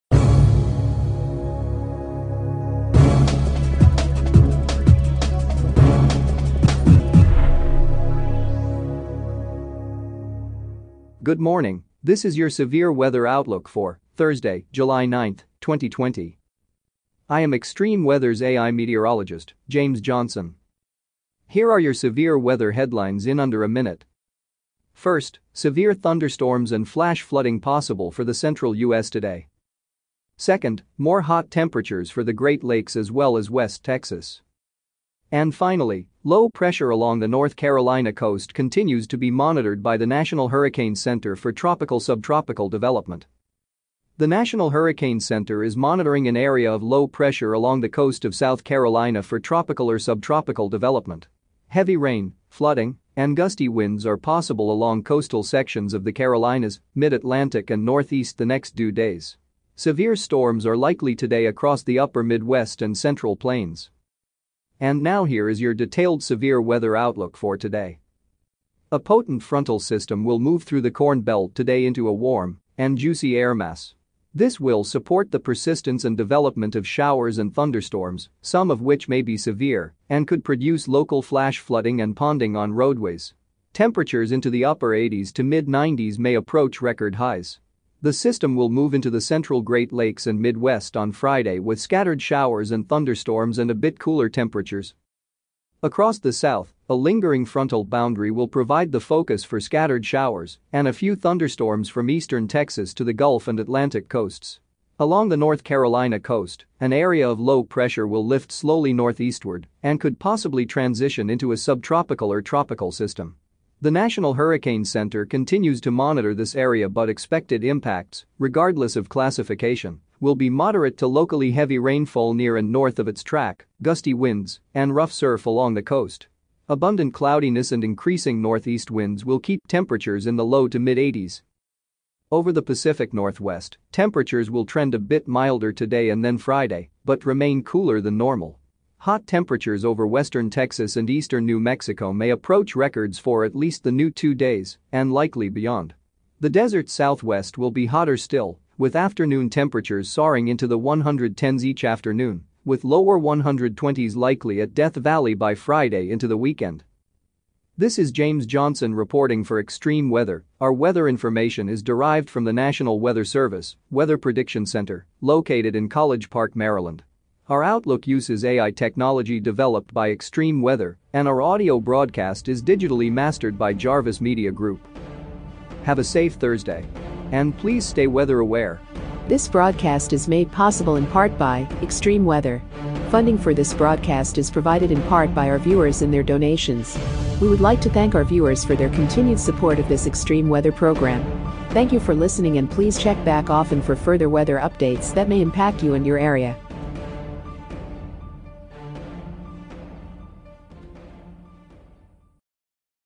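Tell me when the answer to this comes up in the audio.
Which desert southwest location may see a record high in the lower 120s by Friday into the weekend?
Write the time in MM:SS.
02:34.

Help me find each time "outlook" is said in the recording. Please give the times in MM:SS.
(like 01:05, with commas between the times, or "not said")
00:13, 01:06, 02:47.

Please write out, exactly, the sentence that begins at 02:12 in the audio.
Over the Pacific Northwest, temperatures will trend a bit milder today and then Friday, but remain cooler than normal.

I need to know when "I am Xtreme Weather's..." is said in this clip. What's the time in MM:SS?
00:17.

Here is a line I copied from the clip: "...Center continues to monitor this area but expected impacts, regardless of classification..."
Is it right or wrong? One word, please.
right.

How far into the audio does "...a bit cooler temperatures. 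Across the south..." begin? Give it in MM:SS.
01:33.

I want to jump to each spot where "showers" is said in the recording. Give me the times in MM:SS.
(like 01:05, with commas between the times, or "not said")
01:16, 01:32, 01:40.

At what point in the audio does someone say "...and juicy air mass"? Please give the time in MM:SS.
01:12.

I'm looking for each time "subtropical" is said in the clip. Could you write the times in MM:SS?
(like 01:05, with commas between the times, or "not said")
00:42, 00:49, 01:51.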